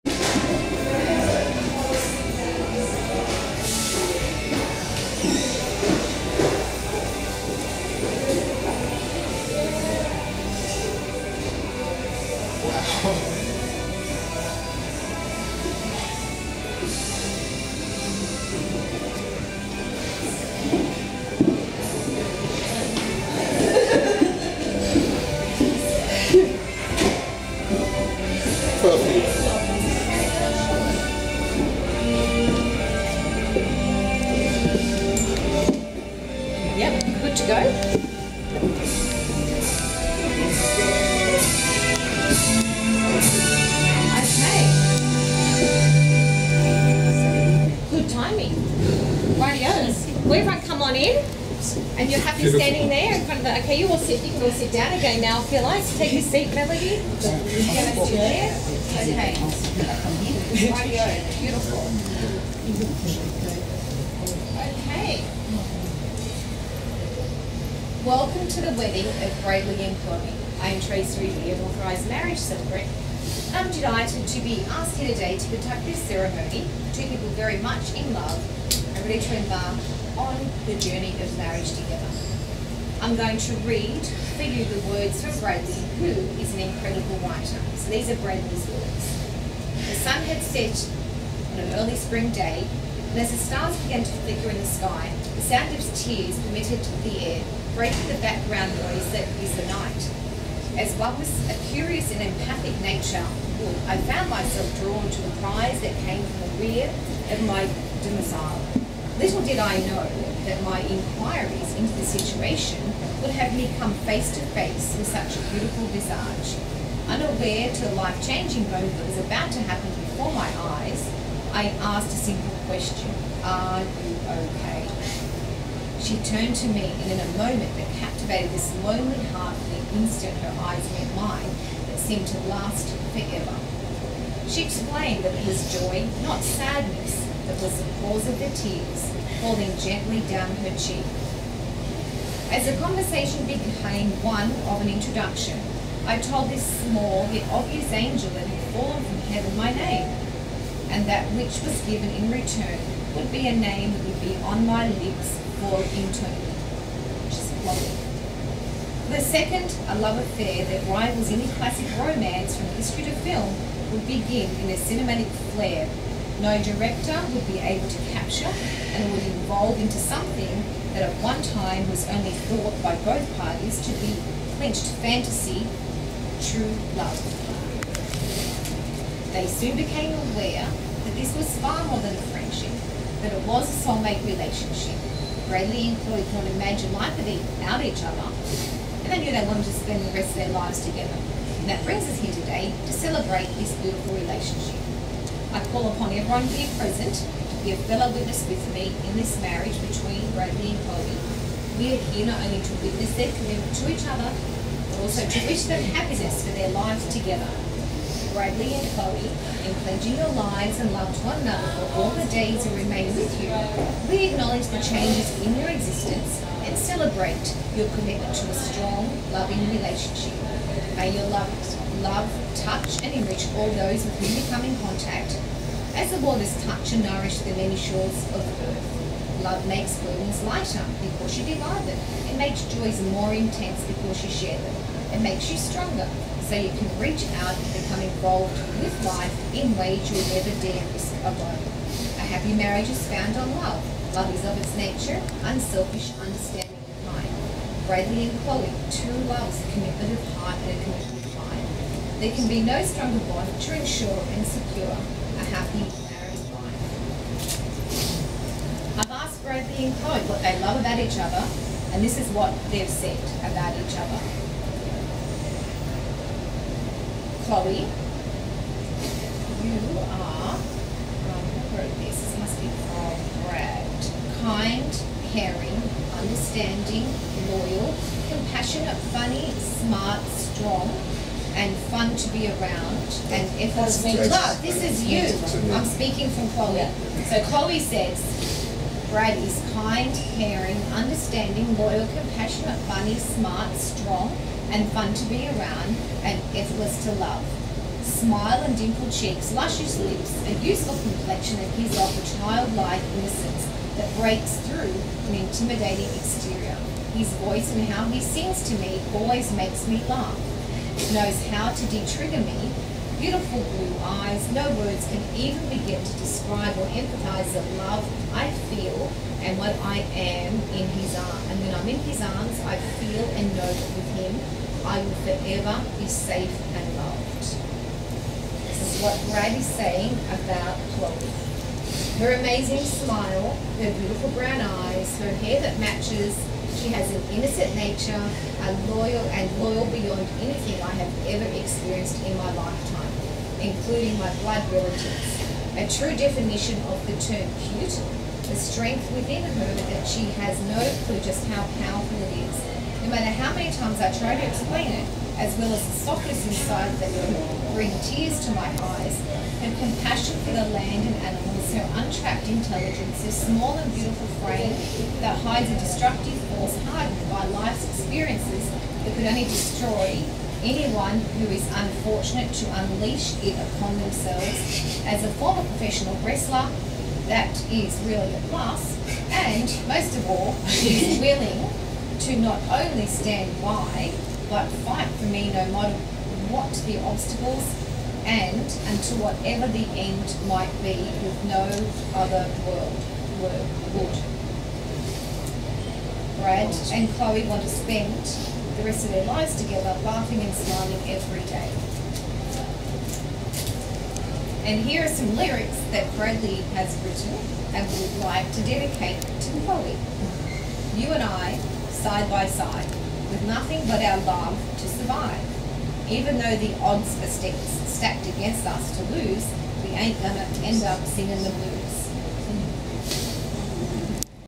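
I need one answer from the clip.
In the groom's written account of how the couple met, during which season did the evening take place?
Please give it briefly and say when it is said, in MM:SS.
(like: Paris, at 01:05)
Spring, at 01:31.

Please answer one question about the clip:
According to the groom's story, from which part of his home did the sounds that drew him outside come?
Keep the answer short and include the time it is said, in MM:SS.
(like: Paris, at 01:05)
The rear, at 01:46.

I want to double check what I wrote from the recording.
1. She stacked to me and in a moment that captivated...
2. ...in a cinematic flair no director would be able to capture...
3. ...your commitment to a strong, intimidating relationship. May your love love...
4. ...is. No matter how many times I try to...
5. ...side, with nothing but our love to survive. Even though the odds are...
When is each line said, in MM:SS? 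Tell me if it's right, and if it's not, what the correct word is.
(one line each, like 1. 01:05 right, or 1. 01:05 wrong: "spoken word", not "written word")
1. 02:06 wrong: "turned", not "stacked"
2. 02:44 right
3. 03:37 wrong: "loving", not "intimidating"
4. 05:52 right
5. 06:52 right.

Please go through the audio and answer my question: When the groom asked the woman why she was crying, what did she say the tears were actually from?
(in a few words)
Joy.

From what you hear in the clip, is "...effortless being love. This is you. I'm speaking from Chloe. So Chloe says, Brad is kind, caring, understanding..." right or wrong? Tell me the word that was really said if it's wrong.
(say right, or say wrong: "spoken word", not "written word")
right.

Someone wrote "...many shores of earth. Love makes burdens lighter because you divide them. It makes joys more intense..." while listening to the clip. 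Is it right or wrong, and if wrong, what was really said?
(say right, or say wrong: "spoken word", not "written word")
right.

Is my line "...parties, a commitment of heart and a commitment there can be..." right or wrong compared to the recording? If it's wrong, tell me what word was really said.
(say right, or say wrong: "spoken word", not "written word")
wrong: "loves", not "parties".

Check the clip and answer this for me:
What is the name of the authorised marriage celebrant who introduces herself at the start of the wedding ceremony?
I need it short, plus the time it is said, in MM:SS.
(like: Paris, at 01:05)
Tracey Ruby, at 01:10.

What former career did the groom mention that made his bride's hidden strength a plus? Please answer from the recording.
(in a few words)
Professional wrestler.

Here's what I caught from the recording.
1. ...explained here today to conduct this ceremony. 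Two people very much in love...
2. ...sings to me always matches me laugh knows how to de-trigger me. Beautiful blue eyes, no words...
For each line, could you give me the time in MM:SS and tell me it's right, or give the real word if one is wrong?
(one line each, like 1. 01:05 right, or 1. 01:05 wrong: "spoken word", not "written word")
1. 01:14 wrong: "asked", not "explained"
2. 05:08 wrong: "makes", not "matches".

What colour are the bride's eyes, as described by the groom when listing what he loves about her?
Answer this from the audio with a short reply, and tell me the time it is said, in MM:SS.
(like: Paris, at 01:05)
Brown, at 05:34.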